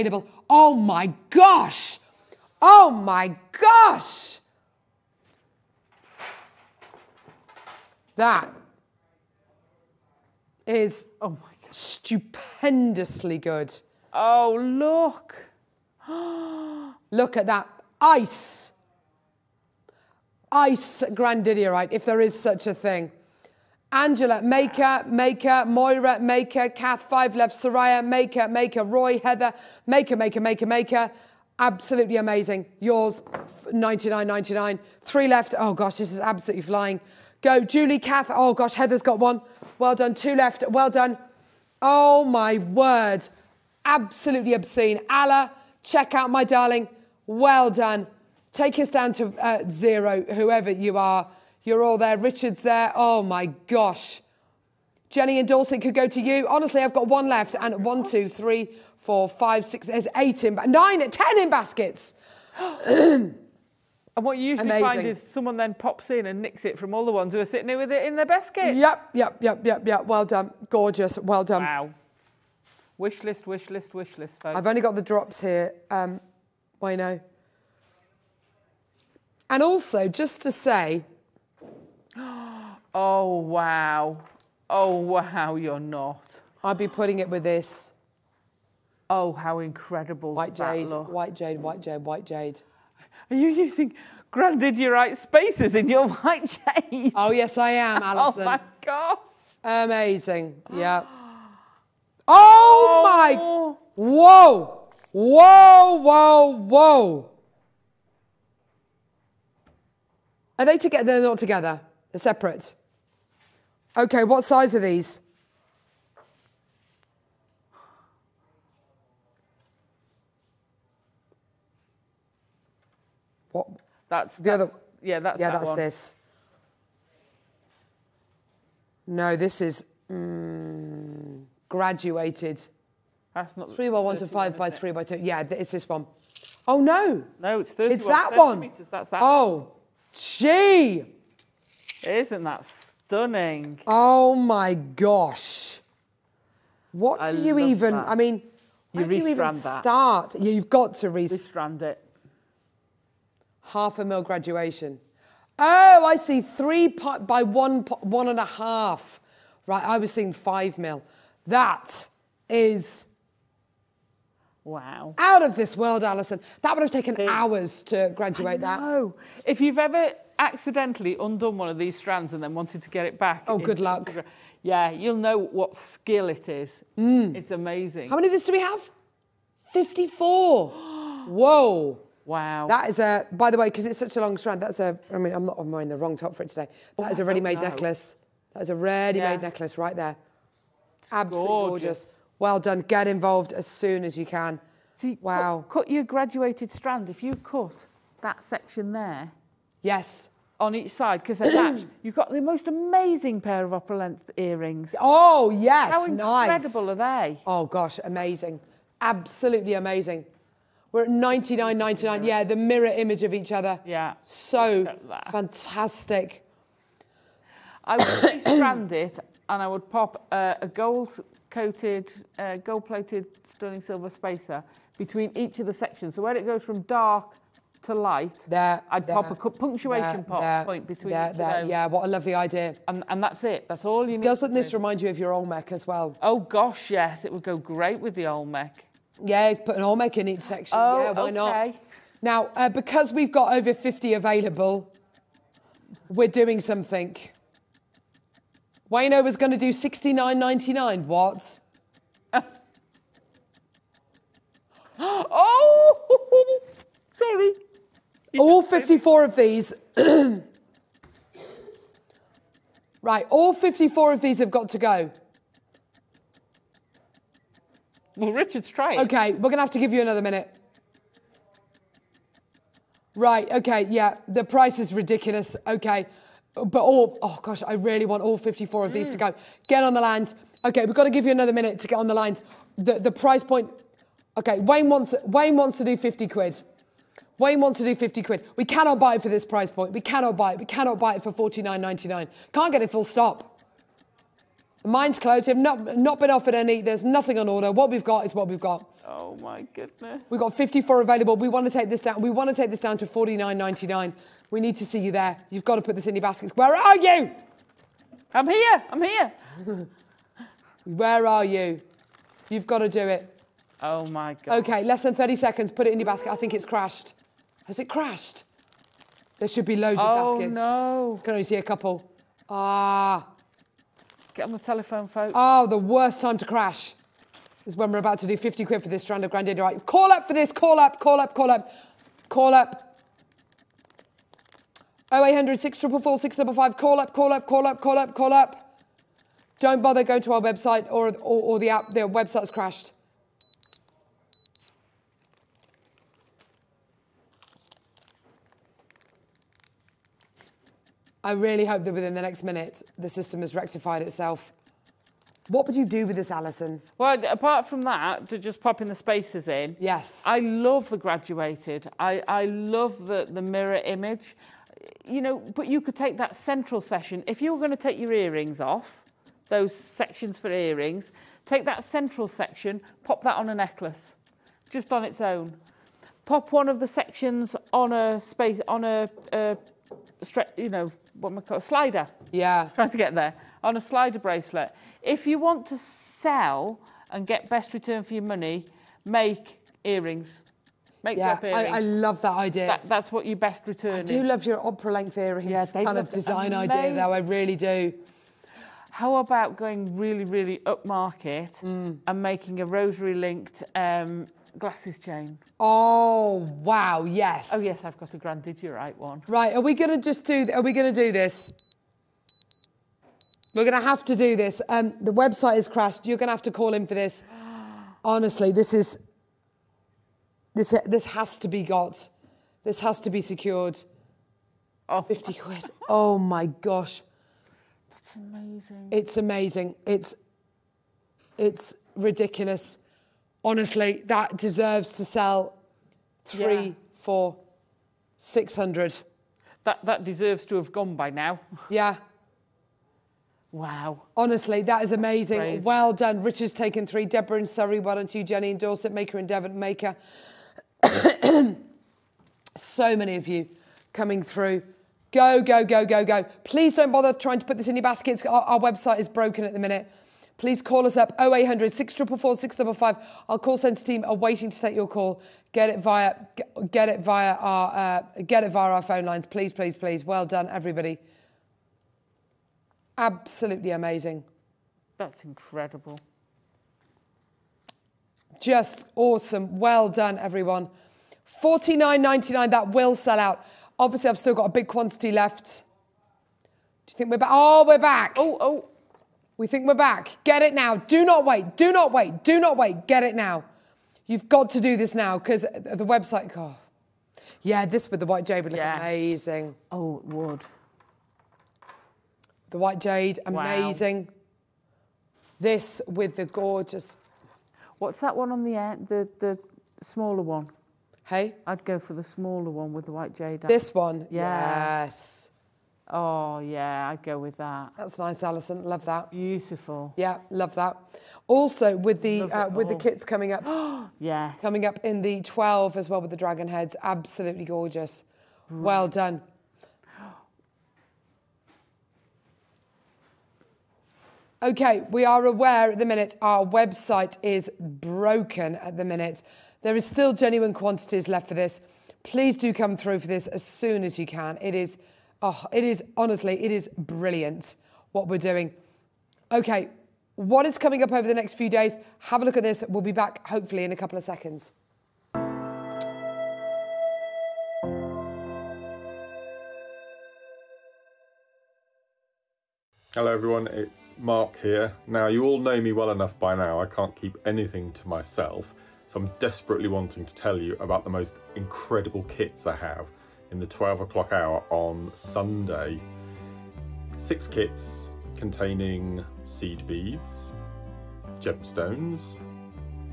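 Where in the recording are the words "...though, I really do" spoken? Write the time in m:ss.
6:36.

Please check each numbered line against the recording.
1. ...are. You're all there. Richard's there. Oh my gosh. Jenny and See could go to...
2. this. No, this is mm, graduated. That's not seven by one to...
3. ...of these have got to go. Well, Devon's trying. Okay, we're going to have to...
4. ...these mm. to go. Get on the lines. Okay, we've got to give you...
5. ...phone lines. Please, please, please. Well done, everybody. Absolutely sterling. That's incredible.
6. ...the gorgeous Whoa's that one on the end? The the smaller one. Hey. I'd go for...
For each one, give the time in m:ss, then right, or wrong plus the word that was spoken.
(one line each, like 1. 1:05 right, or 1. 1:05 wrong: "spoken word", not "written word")
1. 0:50 wrong: "Dorset", not "See"
2. 2:05 wrong: "three", not "seven"
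3. 4:24 wrong: "Richard", not "Devon"
4. 4:38 right
5. 7:48 wrong: "amazing", not "sterling"
6. 8:26 wrong: "What", not "Whoa".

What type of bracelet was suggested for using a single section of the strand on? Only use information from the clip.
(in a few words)
slider bracelet.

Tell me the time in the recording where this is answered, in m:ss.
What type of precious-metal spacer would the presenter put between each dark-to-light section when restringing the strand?
3:42.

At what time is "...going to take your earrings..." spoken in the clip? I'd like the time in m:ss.
6:07.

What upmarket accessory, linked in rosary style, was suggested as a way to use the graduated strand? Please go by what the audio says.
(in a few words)
glasses chain.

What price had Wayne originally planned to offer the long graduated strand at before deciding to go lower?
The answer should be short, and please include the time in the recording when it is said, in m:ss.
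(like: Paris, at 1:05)
69.99, at 4:09.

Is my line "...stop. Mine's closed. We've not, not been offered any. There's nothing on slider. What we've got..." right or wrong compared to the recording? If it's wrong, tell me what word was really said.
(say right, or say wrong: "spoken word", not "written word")
wrong: "order", not "slider".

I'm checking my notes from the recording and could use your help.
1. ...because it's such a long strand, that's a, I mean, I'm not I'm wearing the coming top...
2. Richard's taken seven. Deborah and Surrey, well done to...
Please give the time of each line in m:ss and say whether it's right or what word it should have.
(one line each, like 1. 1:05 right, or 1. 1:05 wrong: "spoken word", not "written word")
1. 3:03 wrong: "wrong", not "coming"
2. 7:26 wrong: "three", not "seven".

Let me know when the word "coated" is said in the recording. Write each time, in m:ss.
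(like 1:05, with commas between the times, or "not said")
3:40.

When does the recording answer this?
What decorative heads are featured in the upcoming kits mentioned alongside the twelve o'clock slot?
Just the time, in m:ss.
8:46.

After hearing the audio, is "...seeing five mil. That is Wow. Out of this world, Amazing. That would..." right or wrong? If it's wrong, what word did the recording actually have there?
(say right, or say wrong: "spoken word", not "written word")
wrong: "Alison", not "Amazing".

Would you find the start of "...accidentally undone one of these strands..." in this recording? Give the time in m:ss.
2:50.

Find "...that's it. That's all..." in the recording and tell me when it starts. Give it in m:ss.
3:53.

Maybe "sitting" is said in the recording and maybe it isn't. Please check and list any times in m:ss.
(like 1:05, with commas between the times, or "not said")
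1:07.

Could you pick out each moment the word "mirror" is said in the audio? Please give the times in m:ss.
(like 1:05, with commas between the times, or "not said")
3:32, 6:03.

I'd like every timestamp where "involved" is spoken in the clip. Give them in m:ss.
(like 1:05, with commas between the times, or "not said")
3:13.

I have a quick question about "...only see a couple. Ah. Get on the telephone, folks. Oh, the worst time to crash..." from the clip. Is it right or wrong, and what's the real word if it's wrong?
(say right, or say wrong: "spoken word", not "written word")
right.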